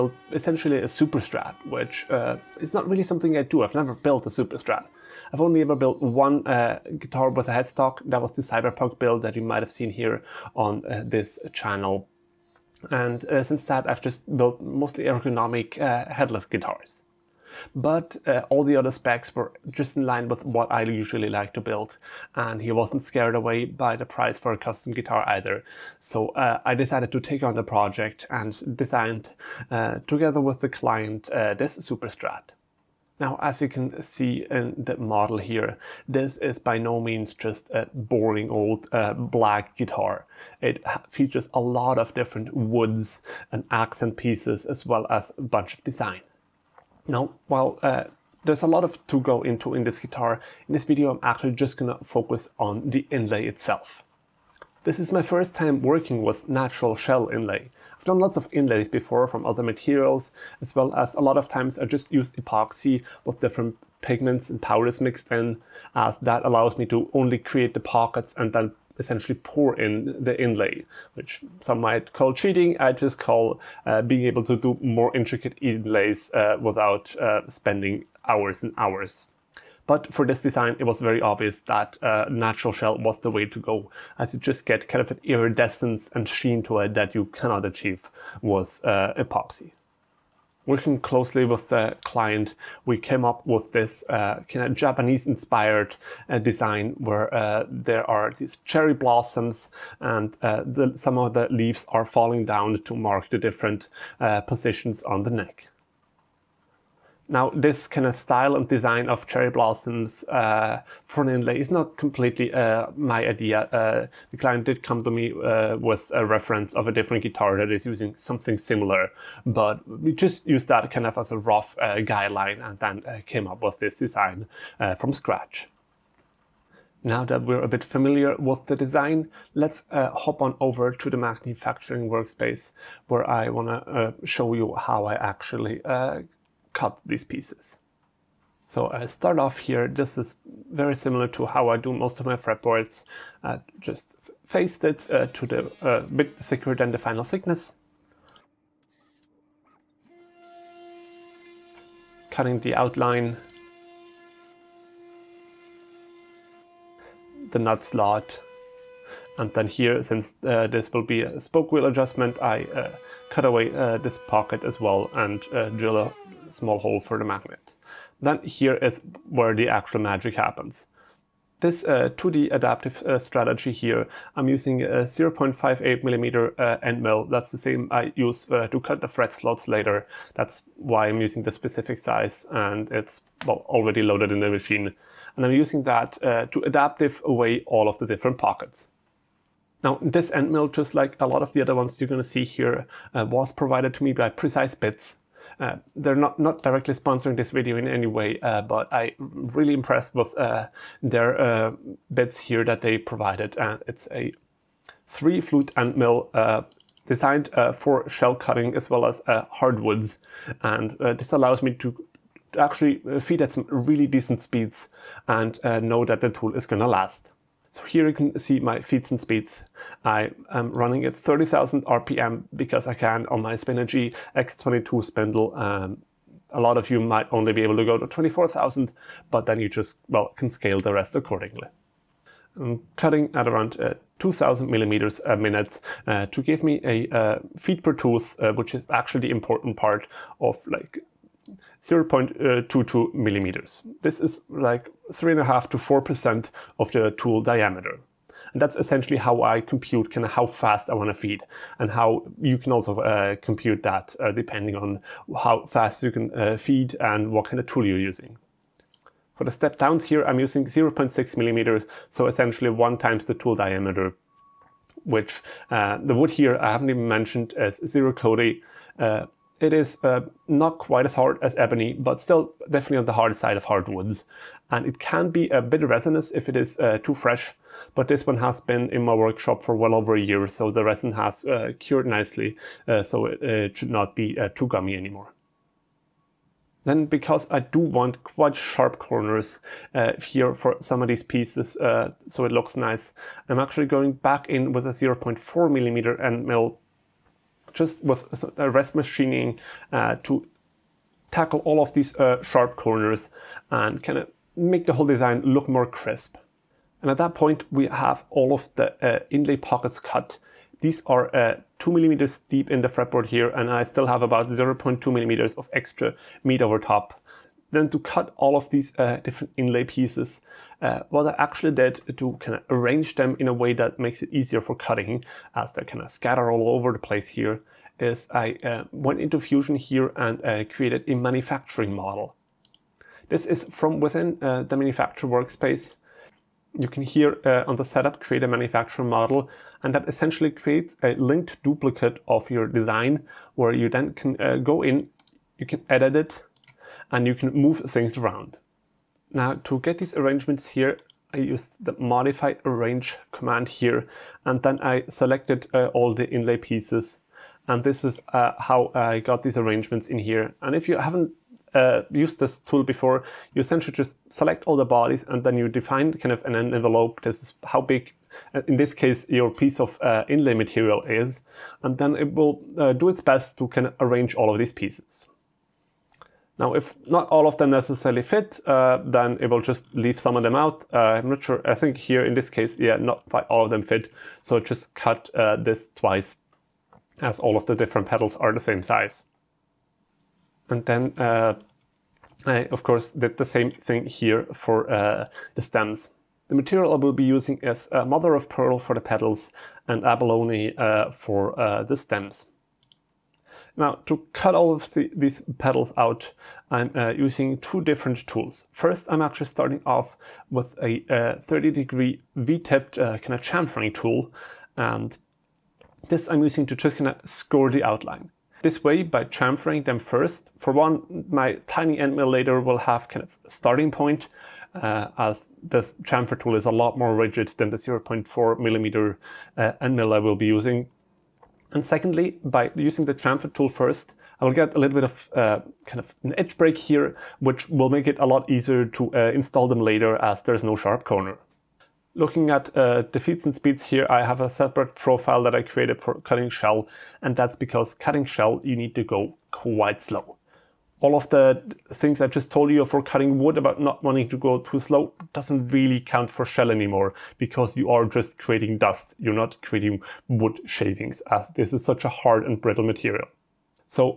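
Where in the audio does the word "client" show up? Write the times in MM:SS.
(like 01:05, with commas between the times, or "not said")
00:30, 01:32, 01:54.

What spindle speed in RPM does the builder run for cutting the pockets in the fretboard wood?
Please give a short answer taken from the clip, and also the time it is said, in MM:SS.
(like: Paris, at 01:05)
30,000, at 03:41.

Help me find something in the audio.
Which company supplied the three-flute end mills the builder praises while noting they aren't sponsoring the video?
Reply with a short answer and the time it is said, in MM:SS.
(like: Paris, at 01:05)
Precise Bits, at 03:14.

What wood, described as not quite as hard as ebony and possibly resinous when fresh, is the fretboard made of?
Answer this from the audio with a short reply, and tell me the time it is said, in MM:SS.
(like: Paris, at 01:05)
Ziricote, at 04:27.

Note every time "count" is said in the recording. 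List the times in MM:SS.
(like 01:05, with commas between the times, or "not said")
07:36.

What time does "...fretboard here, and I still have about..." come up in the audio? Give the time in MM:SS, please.
05:12.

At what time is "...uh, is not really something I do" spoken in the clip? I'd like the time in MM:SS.
00:02.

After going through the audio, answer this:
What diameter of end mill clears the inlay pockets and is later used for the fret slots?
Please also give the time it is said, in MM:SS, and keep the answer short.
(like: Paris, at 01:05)
0.58 mm, at 02:55.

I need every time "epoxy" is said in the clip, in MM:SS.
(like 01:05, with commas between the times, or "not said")
01:02, 01:29.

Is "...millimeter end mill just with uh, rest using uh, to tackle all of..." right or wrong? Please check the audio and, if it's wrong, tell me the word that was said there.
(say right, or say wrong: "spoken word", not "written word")
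wrong: "machining", not "using".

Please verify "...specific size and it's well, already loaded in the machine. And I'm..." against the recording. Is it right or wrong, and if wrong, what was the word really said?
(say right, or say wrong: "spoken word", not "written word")
right.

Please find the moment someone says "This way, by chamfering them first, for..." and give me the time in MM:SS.
06:58.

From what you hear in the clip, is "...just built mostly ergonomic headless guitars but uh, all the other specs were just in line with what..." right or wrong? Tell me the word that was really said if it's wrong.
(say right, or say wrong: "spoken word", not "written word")
right.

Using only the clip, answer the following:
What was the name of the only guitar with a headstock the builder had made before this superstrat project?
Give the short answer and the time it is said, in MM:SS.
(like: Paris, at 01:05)
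The cyberpunk build, at 00:08.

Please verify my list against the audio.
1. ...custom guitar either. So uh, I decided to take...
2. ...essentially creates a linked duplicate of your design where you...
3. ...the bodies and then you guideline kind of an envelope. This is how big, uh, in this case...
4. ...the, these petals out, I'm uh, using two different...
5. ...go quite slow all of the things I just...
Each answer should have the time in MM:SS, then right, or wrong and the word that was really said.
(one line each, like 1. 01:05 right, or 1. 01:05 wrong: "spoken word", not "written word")
1. 00:24 right
2. 05:40 right
3. 06:04 wrong: "define", not "guideline"
4. 06:44 right
5. 07:29 right.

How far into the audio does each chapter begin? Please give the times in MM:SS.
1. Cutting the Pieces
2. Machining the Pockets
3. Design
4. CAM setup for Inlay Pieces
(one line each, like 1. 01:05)
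1. 06:42
2. 02:07
3. 00:32
4. 05:17.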